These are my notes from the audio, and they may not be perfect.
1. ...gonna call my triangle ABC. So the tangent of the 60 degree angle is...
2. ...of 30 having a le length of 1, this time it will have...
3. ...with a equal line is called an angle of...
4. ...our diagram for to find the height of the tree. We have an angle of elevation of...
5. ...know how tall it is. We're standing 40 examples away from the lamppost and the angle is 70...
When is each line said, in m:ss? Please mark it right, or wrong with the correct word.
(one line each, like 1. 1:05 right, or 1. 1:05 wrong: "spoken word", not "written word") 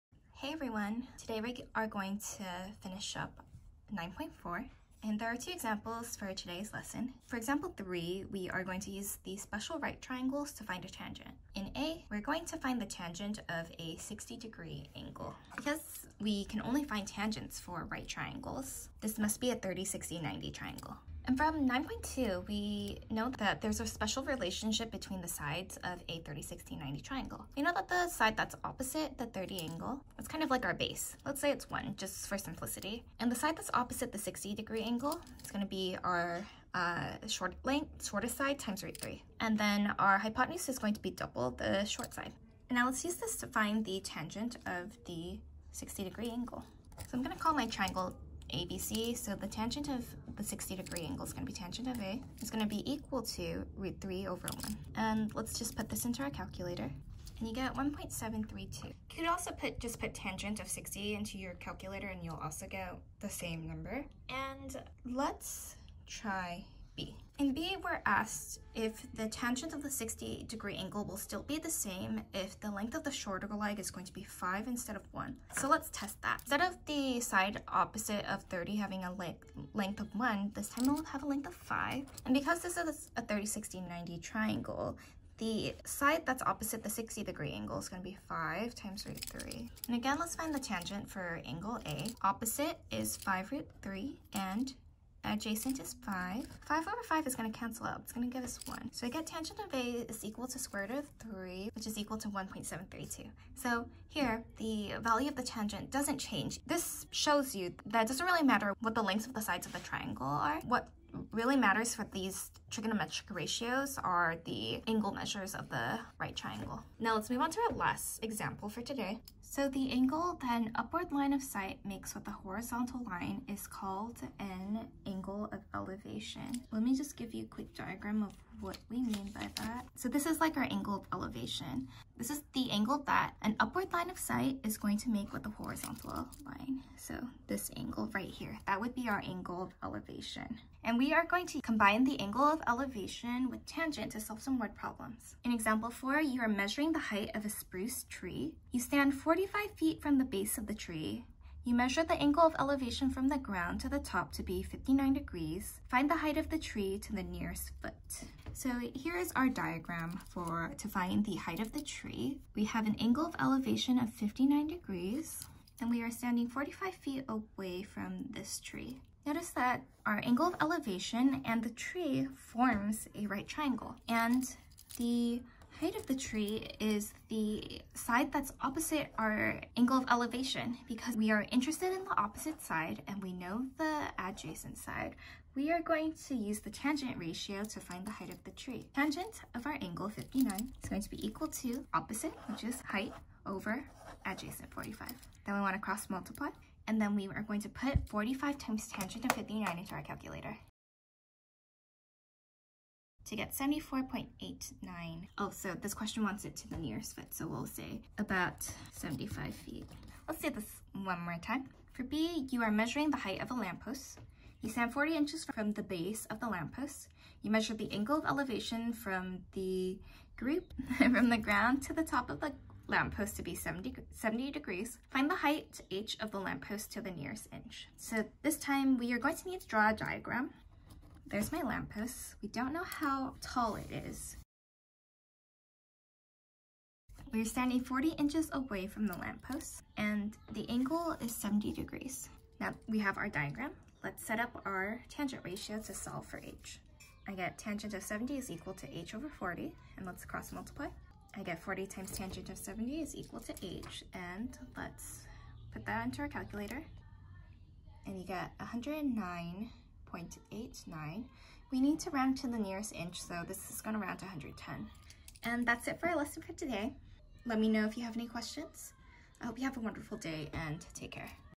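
1. 0:47 right
2. 1:18 right
3. 2:02 wrong: "horizontal", not "equal"
4. 2:39 right
5. 3:52 wrong: "inches", not "examples".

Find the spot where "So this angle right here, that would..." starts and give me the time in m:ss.
2:16.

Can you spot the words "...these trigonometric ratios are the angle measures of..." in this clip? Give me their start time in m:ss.
1:52.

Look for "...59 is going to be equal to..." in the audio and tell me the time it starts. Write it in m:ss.
3:10.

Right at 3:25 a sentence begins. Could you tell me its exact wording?
Oh, so this question wants it to the nearest foot, so we'll say about 75 feet.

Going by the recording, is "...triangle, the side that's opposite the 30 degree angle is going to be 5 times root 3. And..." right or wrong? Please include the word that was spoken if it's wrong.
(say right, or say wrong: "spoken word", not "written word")
wrong: "60", not "30".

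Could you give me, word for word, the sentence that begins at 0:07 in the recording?
For example 3, we are going to use the special right triangles to find a tangent.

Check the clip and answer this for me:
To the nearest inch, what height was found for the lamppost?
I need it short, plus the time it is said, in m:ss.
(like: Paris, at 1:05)
110, at 4:24.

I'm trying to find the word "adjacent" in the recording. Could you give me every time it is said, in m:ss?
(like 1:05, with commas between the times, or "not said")
1:35, 3:04, 3:14.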